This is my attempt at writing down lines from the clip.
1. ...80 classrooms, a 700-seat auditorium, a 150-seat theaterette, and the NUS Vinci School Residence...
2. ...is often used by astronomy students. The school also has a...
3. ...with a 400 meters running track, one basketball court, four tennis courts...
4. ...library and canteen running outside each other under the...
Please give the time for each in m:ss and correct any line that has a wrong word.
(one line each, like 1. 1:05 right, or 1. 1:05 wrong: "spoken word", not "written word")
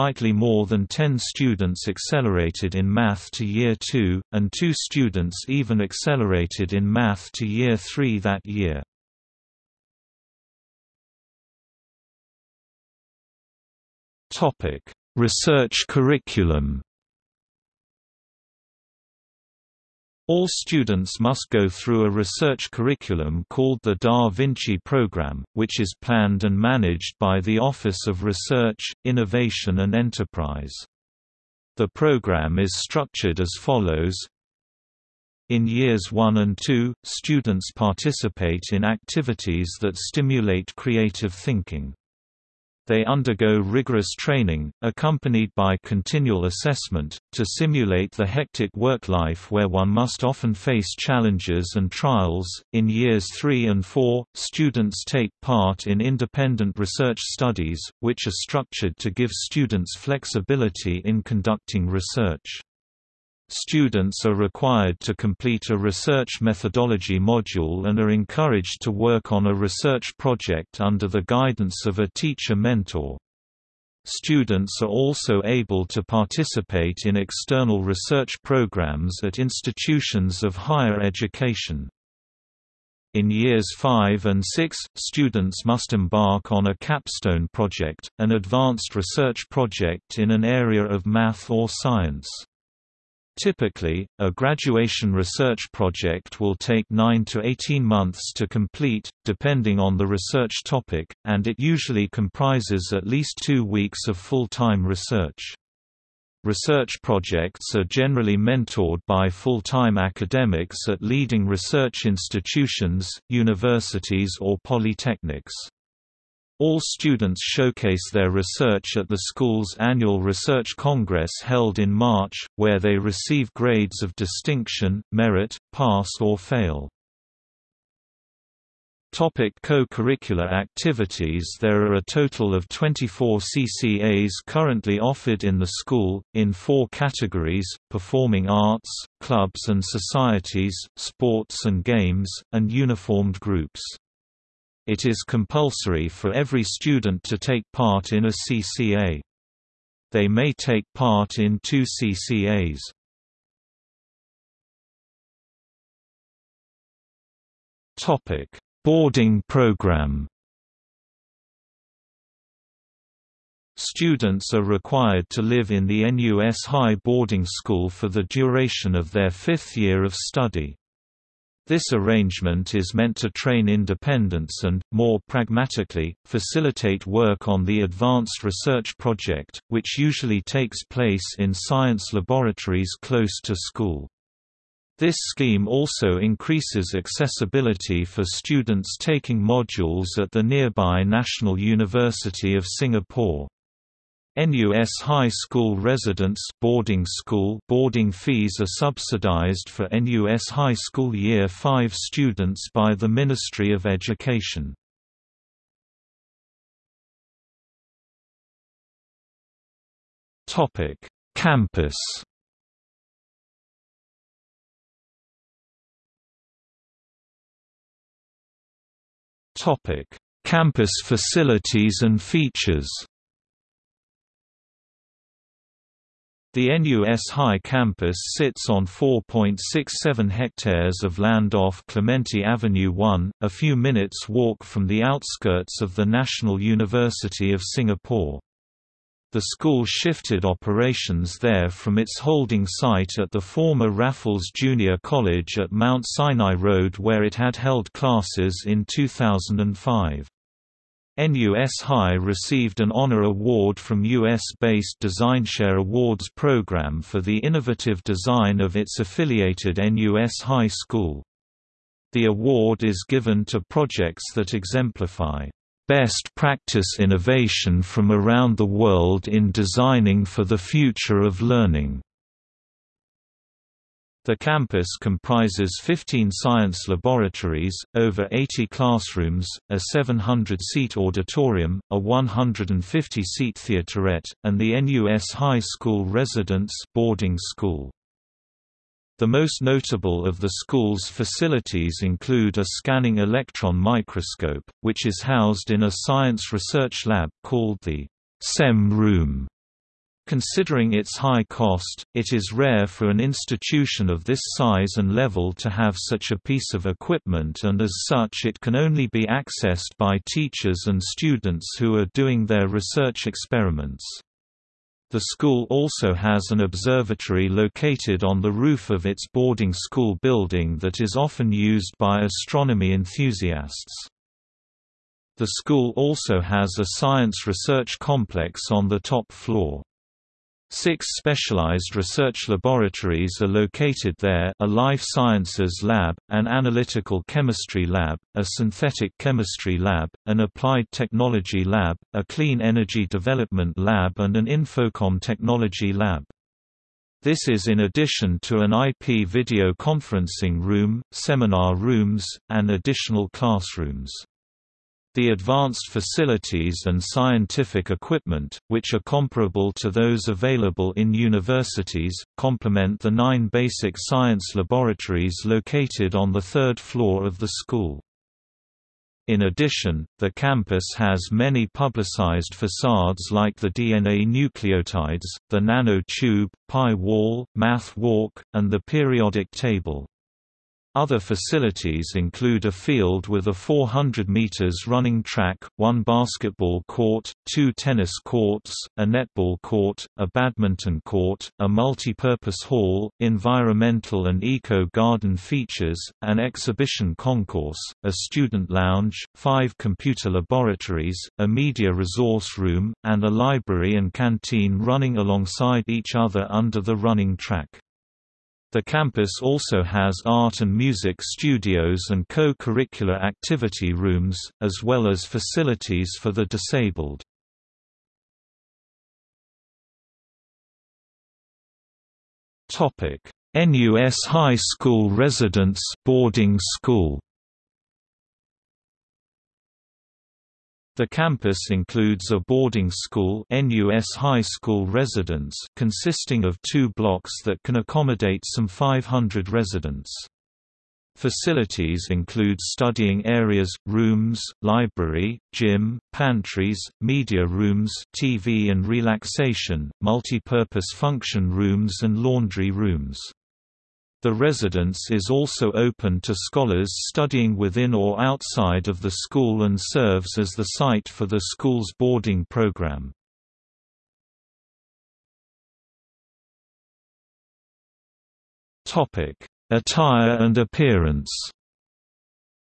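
1. 4:38 wrong: "High", not "Vinci"
2. 5:20 wrong: "enthusiasts", not "students"
3. 6:23 wrong: "two", not "four"
4. 6:43 wrong: "alongside", not "outside".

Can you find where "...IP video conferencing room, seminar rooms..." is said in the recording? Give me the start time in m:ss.
5:48.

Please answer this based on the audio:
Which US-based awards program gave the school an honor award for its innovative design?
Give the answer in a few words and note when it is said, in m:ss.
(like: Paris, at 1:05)
DesignShare Awards, at 4:15.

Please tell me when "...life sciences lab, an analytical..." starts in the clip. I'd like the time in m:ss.
5:34.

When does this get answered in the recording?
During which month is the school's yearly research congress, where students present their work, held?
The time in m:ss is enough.
2:01.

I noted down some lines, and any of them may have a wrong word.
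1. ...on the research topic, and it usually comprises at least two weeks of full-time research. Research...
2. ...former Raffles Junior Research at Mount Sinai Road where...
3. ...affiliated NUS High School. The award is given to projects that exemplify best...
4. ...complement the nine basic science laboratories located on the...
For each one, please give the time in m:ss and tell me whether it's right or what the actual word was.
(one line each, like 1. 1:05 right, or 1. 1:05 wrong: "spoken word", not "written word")
1. 1:39 right
2. 4:03 wrong: "College", not "Research"
3. 4:18 right
4. 6:02 right.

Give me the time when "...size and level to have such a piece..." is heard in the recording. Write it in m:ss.
5:04.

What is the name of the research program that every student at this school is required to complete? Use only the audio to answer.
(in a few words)
Da Vinci Program.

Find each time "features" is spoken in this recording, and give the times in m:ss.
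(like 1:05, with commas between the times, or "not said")
3:42, 6:35.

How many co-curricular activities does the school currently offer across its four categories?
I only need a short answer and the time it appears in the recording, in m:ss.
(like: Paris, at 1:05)
24, at 2:12.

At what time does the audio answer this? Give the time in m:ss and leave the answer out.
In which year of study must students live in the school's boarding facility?
2:49.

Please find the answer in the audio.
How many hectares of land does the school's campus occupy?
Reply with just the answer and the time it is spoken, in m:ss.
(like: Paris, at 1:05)
4.67, at 3:48.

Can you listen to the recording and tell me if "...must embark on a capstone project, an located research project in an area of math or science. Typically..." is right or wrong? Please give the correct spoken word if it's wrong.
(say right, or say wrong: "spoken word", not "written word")
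wrong: "advanced", not "located".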